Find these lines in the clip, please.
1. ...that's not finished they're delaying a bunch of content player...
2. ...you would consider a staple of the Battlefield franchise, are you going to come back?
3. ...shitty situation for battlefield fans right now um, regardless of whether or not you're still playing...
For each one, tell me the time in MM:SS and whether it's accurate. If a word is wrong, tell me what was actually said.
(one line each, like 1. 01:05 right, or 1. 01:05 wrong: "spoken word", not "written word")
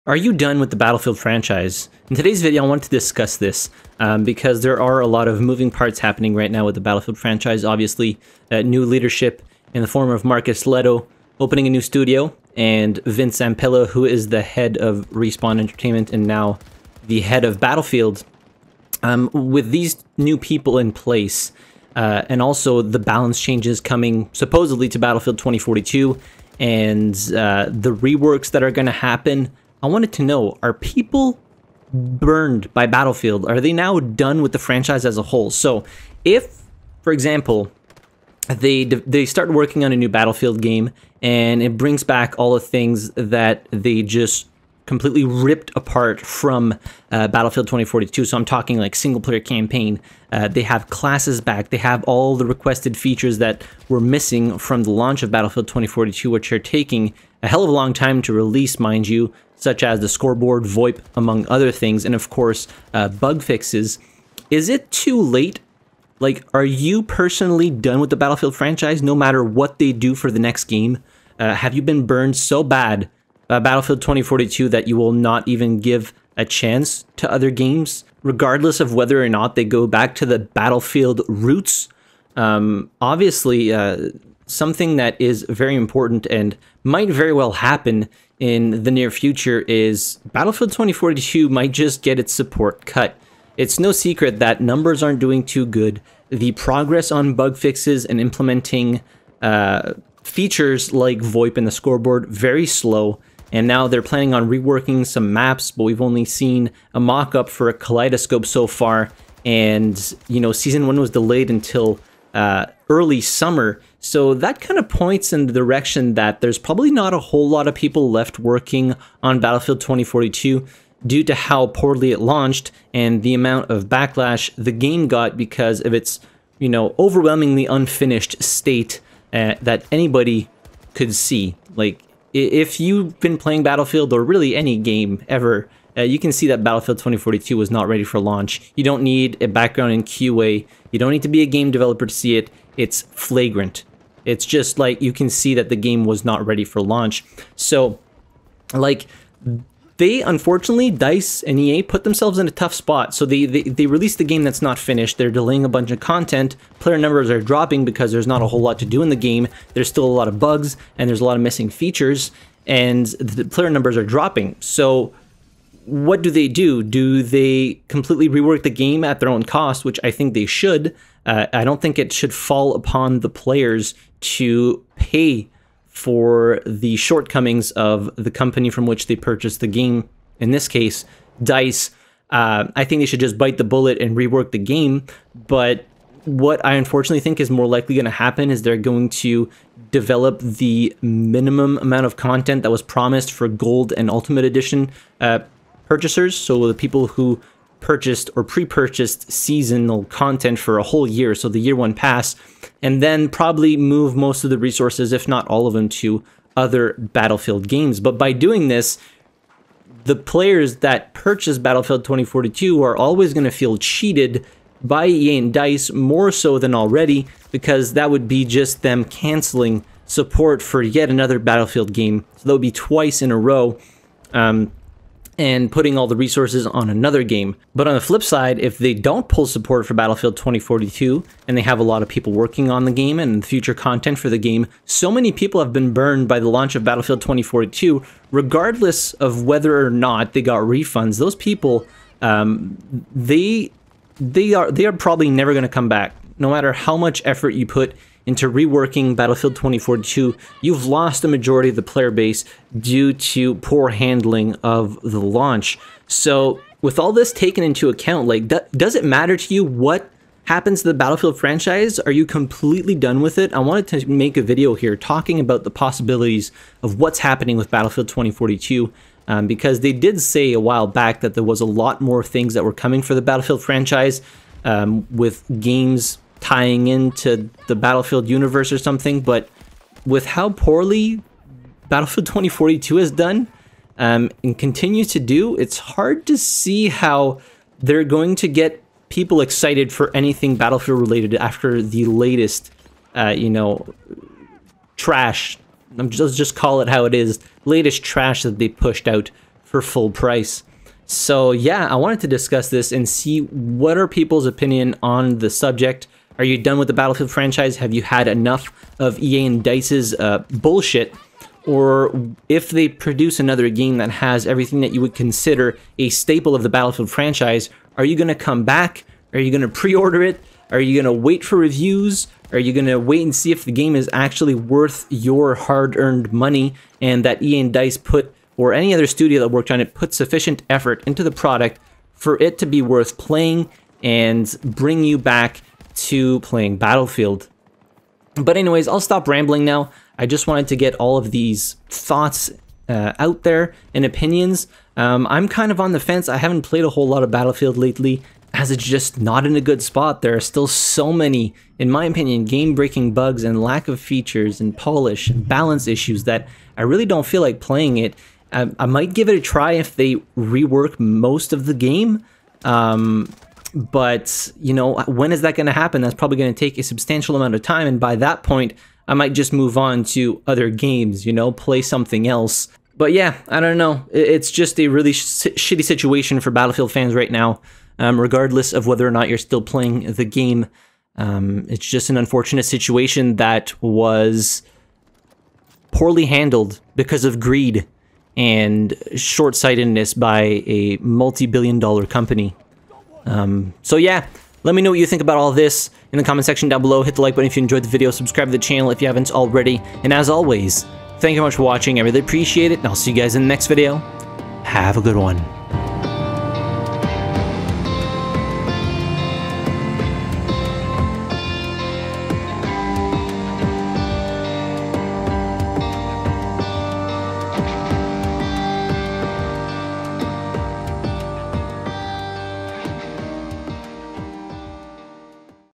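1. 02:34 right
2. 05:14 right
3. 06:15 right.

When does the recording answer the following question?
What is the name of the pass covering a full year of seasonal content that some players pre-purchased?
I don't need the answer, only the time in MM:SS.
03:21.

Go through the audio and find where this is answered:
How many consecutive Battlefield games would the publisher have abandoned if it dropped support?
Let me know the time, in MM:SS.
03:42.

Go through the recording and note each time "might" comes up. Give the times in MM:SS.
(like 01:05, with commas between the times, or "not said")
01:26, 01:31, 05:58, 06:09.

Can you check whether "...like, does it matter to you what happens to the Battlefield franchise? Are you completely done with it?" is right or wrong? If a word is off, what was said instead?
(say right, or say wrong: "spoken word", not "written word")
right.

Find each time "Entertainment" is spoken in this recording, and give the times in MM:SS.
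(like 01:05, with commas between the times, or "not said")
00:15.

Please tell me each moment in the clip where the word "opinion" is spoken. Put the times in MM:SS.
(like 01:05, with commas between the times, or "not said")
05:04, 05:44, 05:52.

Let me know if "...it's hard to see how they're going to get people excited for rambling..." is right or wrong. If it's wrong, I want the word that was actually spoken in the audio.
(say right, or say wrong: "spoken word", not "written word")
wrong: "anything", not "rambling".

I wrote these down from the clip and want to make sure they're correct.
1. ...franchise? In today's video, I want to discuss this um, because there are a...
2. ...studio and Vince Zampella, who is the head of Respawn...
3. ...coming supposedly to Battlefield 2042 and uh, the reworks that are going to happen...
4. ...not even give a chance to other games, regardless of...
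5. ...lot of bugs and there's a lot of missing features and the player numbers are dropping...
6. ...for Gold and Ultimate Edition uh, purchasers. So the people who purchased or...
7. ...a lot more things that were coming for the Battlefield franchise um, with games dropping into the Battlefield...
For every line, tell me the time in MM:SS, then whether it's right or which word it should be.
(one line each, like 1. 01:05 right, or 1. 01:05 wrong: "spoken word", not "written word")
1. 00:01 right
2. 00:11 right
3. 00:23 right
4. 01:15 right
5. 02:40 right
6. 03:13 right
7. 04:31 wrong: "tying", not "dropping".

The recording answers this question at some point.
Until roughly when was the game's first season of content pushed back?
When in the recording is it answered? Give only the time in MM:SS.
01:52.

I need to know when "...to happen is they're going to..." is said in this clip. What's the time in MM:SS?
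03:08.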